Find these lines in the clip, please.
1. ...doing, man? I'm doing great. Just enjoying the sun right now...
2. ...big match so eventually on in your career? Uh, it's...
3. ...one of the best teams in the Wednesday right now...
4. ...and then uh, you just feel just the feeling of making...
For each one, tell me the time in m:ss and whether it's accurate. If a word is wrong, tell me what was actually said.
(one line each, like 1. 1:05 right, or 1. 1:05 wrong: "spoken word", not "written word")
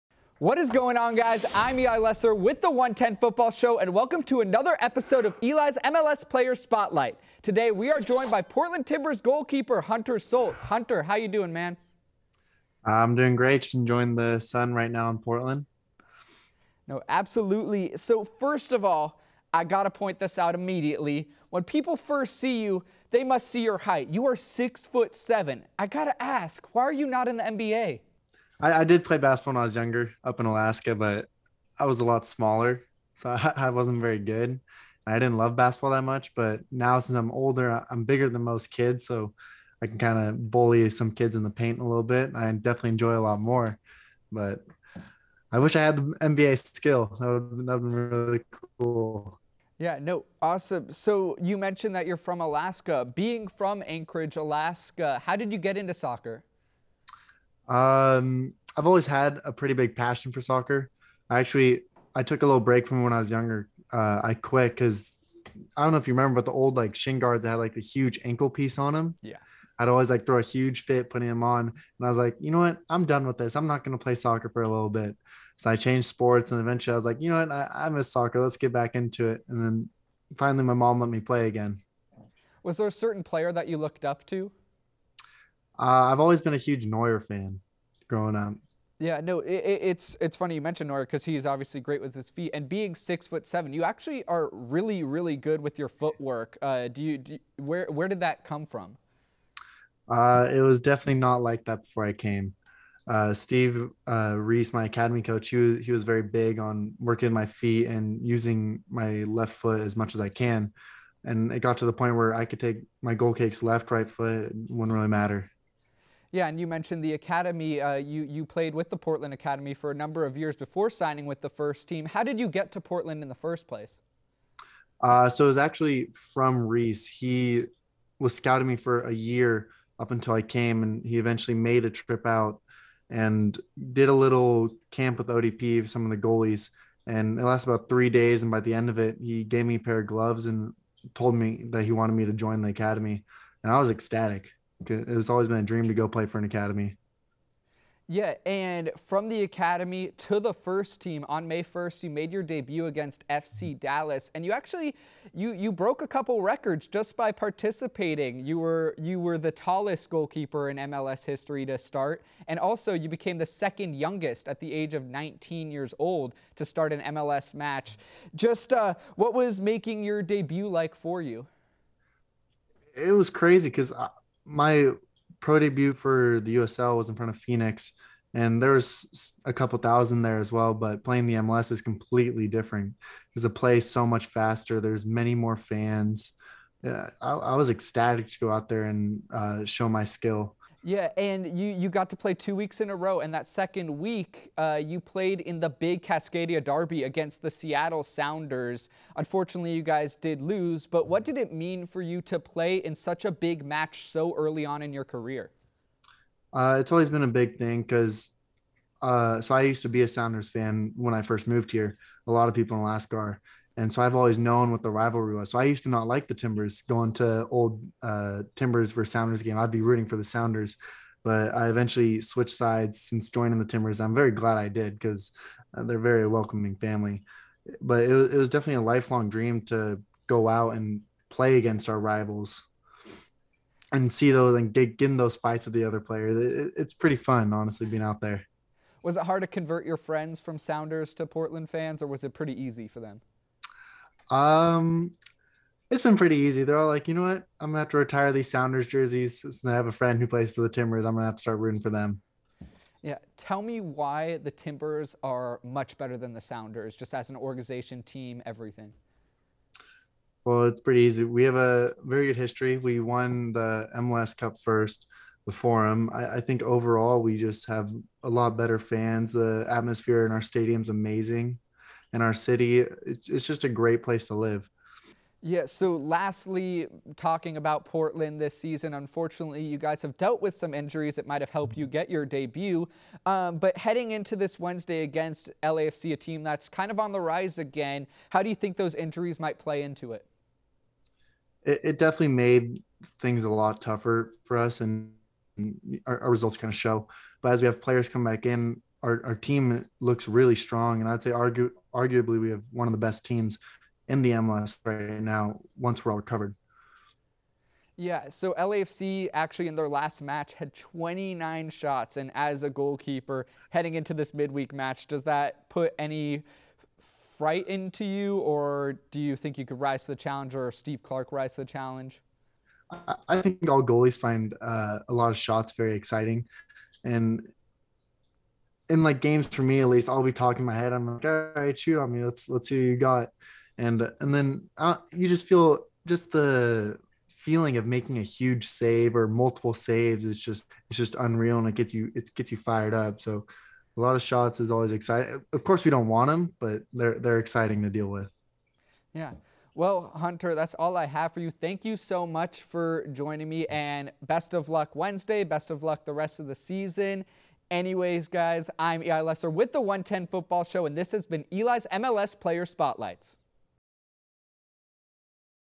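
1. 0:11 right
2. 3:23 wrong: "early", not "eventually"
3. 5:02 wrong: "MLS", not "Wednesday"
4. 5:34 right.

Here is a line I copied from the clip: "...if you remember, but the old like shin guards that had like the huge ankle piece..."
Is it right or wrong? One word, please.
right.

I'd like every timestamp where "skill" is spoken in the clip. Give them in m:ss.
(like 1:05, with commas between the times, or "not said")
0:46, 3:10.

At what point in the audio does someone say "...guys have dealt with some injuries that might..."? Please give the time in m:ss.
4:39.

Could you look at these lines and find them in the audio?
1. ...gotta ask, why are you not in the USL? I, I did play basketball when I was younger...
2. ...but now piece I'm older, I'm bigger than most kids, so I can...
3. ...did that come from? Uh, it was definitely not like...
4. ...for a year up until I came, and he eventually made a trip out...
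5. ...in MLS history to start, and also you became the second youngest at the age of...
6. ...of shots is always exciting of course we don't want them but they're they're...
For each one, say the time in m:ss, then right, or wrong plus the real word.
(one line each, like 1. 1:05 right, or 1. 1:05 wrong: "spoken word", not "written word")
1. 0:25 wrong: "NBA", not "USL"
2. 0:36 wrong: "since", not "piece"
3. 1:38 right
4. 2:08 right
5. 2:40 right
6. 5:44 right.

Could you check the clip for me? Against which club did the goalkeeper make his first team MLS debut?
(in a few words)
FC Dallas.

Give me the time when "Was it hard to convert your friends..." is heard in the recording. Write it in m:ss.
3:59.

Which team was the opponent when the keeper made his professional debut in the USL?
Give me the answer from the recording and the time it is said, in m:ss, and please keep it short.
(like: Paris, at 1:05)
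Phoenix, at 2:57.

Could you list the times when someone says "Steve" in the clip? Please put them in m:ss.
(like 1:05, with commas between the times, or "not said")
1:43, 5:20.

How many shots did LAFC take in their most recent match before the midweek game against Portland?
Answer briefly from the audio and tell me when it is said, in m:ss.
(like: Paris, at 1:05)
29, at 5:10.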